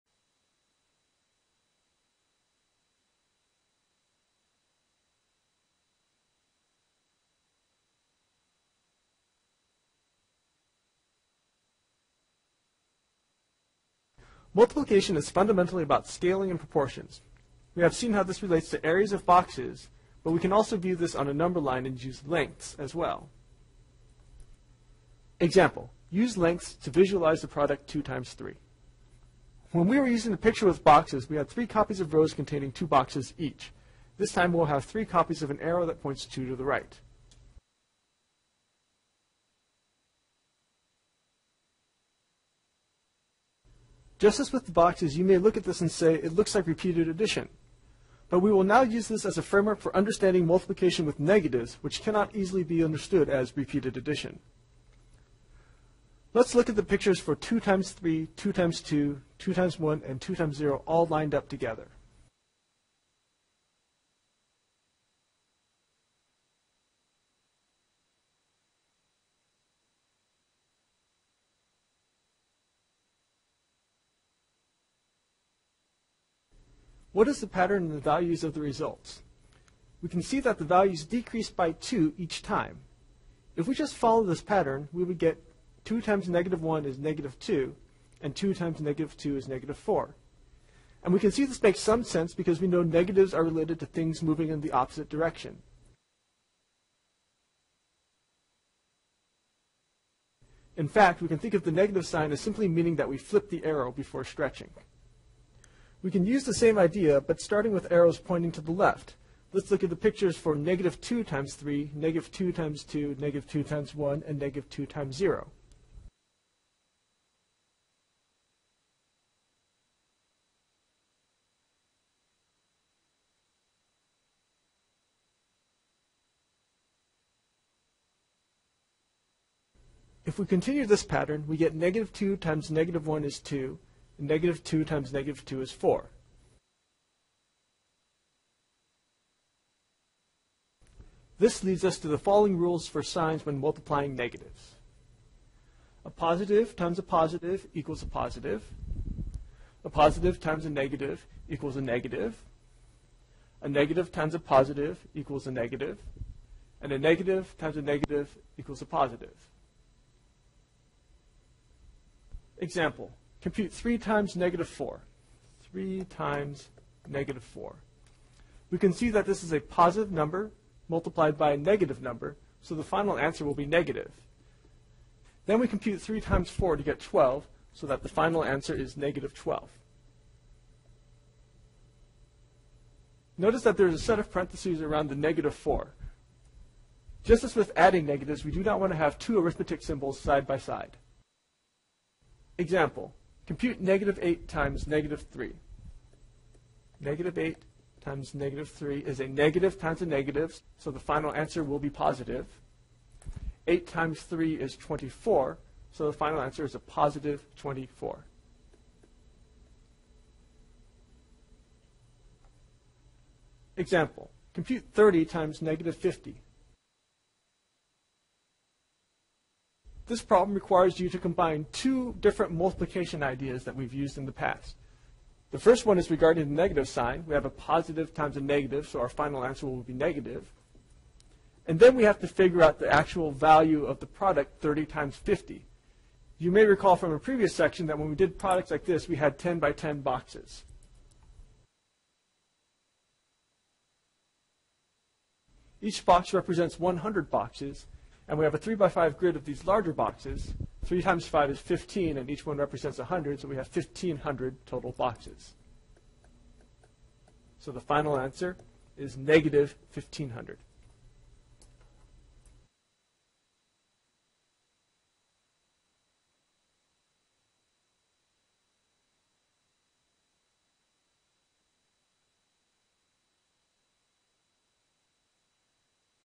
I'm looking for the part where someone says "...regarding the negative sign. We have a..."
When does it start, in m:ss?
3:46.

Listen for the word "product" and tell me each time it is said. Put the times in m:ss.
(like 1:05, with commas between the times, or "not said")
0:27, 3:54, 3:58.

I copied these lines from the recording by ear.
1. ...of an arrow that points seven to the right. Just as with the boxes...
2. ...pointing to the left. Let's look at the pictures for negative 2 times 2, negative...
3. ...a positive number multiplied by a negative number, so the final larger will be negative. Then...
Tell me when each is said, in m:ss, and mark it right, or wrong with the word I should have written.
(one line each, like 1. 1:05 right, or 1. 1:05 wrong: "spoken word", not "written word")
1. 0:35 wrong: "two", not "seven"
2. 1:48 wrong: "3", not "2"
3. 2:49 wrong: "answer", not "larger".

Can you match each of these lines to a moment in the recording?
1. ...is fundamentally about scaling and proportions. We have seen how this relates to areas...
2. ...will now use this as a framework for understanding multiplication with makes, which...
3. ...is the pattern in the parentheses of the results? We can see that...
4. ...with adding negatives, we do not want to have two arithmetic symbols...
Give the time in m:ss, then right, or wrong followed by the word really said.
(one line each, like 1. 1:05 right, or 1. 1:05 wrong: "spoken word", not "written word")
1. 0:15 right
2. 0:48 wrong: "negatives", not "makes"
3. 1:17 wrong: "values", not "parentheses"
4. 3:07 right.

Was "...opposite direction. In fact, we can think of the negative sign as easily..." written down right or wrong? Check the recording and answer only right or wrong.
wrong.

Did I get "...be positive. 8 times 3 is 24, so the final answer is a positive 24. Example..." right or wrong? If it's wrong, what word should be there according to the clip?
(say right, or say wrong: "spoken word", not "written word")
right.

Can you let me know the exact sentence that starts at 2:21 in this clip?
This leads us to the following rules for signs when multiplying negatives.